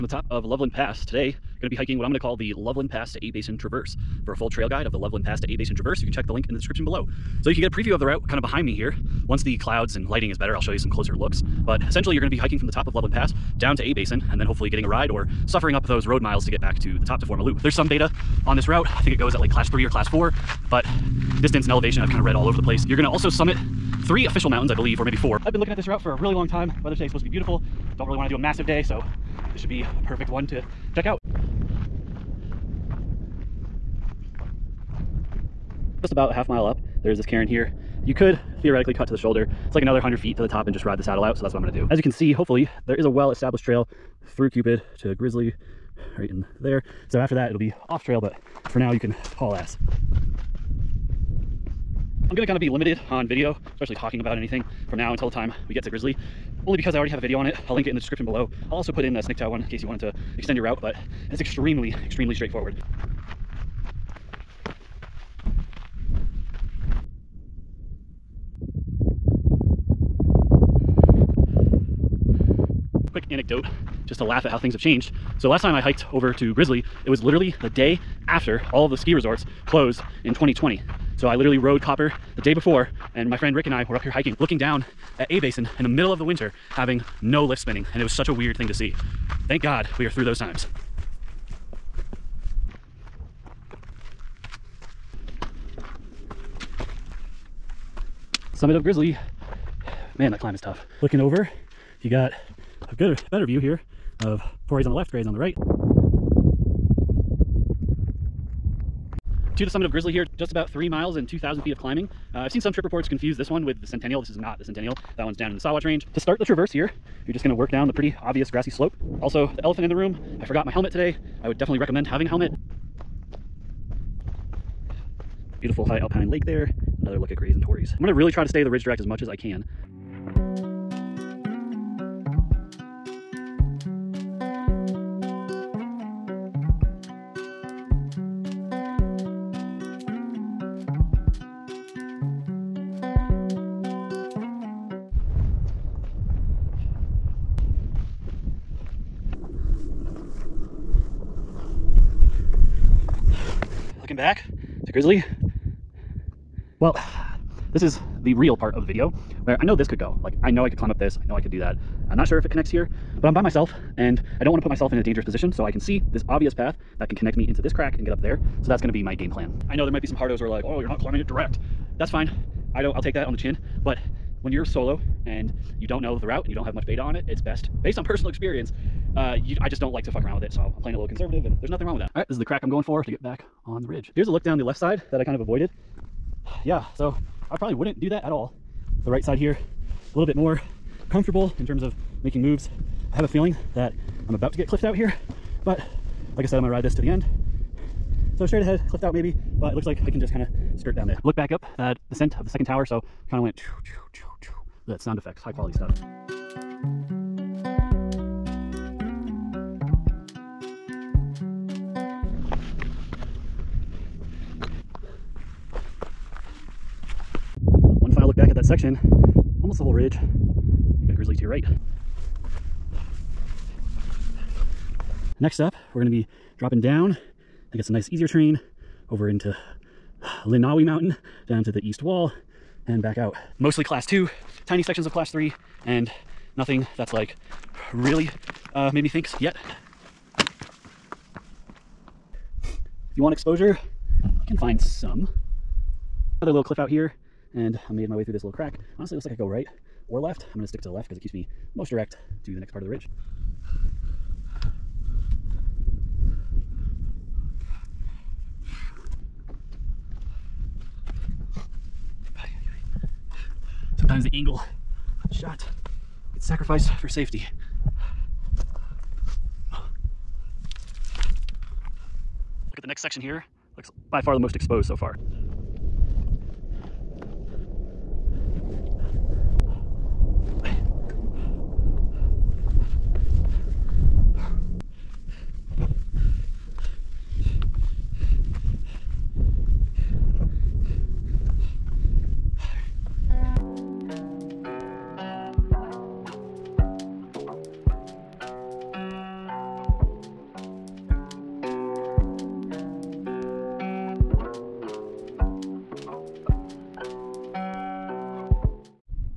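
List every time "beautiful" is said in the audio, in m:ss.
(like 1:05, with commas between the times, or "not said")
0:27, 2:05.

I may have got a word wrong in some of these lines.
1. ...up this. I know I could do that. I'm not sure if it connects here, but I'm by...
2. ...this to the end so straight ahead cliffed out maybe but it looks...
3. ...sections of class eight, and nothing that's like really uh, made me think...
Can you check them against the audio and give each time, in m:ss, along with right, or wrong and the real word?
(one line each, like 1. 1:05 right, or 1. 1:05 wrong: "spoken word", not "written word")
1. 2:40 right
2. 3:16 right
3. 3:54 wrong: "three", not "eight".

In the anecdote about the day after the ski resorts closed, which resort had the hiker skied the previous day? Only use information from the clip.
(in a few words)
Copper.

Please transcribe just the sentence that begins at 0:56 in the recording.
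Only because I already have a video on it.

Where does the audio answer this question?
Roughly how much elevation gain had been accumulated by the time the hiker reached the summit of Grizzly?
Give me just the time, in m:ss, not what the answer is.
1:51.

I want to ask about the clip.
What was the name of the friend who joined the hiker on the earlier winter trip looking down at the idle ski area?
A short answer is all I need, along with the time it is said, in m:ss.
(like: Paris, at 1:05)
Rick, at 1:23.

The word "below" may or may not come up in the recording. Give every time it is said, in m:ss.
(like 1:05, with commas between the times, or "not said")
0:06, 0:58.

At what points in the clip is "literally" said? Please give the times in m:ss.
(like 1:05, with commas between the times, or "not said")
1:17, 1:21.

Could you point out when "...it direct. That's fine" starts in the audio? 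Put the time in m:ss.
2:51.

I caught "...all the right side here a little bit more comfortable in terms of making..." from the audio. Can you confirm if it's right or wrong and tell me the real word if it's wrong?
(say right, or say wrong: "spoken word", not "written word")
right.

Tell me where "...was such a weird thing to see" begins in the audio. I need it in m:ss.
1:28.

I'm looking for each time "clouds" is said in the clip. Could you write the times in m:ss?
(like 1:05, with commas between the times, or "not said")
0:09.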